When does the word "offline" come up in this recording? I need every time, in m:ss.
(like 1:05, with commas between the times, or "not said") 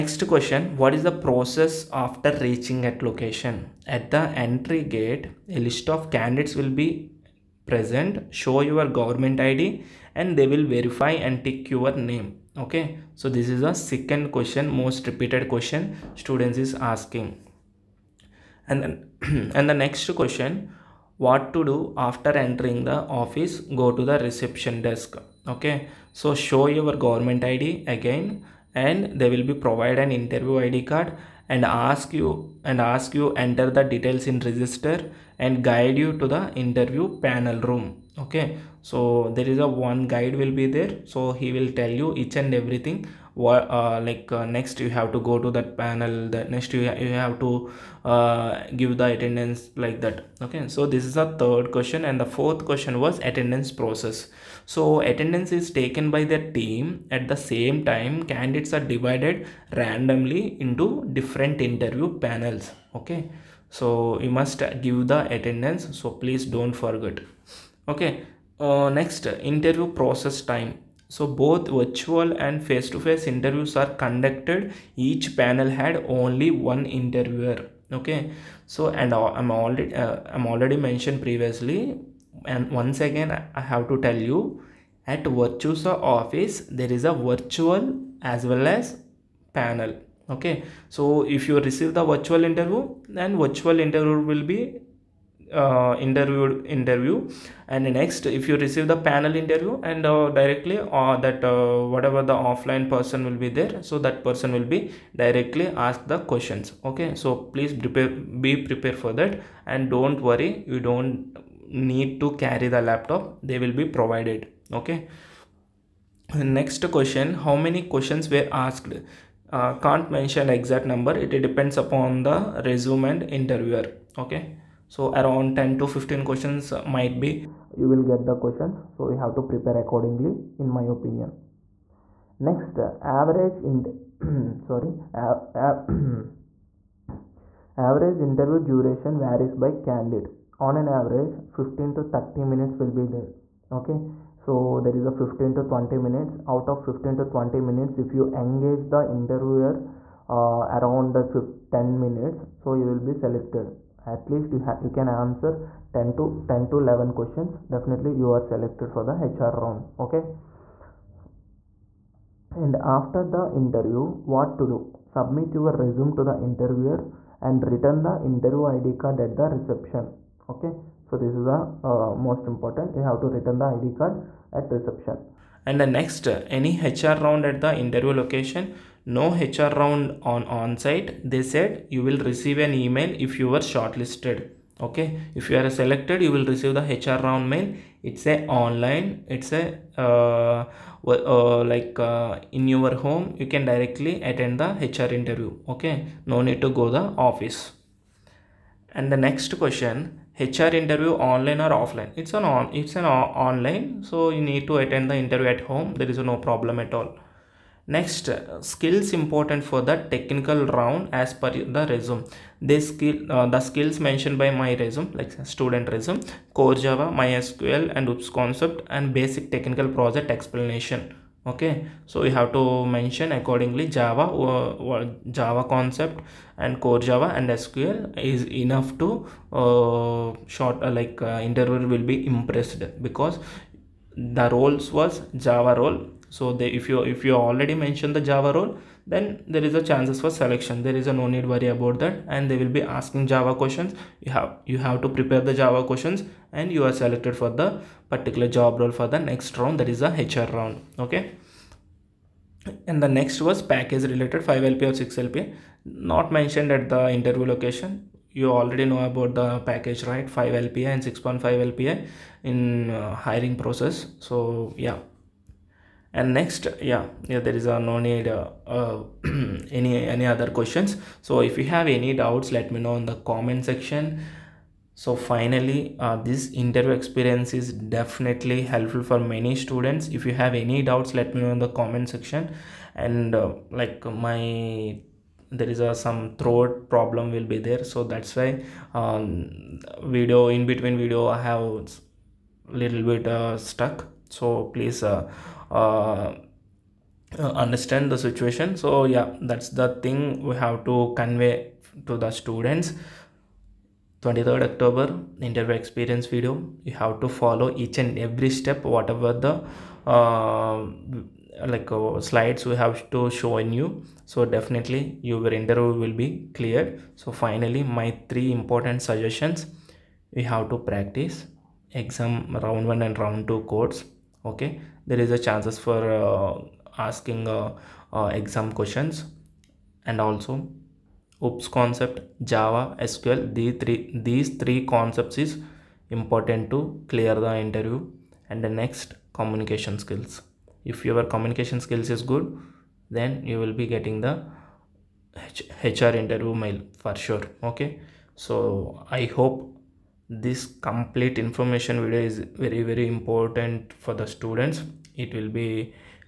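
1:42, 3:21.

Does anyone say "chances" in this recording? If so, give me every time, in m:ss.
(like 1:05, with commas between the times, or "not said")
3:59, 5:25.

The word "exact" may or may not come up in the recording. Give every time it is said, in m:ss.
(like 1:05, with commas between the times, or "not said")
2:00.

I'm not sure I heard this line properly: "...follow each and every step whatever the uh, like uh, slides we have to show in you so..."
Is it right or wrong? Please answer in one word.
right.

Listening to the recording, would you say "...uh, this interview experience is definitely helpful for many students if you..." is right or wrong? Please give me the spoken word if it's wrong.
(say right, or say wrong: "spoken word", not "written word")
right.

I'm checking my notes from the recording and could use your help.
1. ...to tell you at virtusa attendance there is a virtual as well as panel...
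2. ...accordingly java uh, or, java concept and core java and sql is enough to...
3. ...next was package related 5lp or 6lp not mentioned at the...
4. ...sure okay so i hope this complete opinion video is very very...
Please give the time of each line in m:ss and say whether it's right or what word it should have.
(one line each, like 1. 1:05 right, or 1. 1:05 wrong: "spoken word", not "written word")
1. 1:23 wrong: "office", not "attendance"
2. 3:43 right
3. 4:13 right
4. 5:47 wrong: "information", not "opinion".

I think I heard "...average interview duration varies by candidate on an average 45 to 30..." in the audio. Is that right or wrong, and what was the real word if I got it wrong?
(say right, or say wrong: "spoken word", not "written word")
wrong: "15", not "45".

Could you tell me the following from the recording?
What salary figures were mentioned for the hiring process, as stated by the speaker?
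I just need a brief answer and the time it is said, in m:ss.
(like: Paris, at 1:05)
5 LPA and 6.5 LPA, at 4:20.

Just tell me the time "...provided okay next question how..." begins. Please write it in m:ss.
1:53.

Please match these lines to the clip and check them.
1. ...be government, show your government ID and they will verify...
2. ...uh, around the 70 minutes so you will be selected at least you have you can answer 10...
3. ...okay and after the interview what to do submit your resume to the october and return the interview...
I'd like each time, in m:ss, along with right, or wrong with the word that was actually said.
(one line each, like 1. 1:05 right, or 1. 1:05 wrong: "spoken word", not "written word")
1. 0:06 wrong: "present", not "government"
2. 2:30 wrong: "10", not "70"
3. 2:40 wrong: "interviewer", not "october".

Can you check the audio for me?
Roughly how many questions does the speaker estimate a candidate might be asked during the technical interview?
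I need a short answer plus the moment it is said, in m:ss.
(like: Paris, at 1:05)
10 to 15, at 2:05.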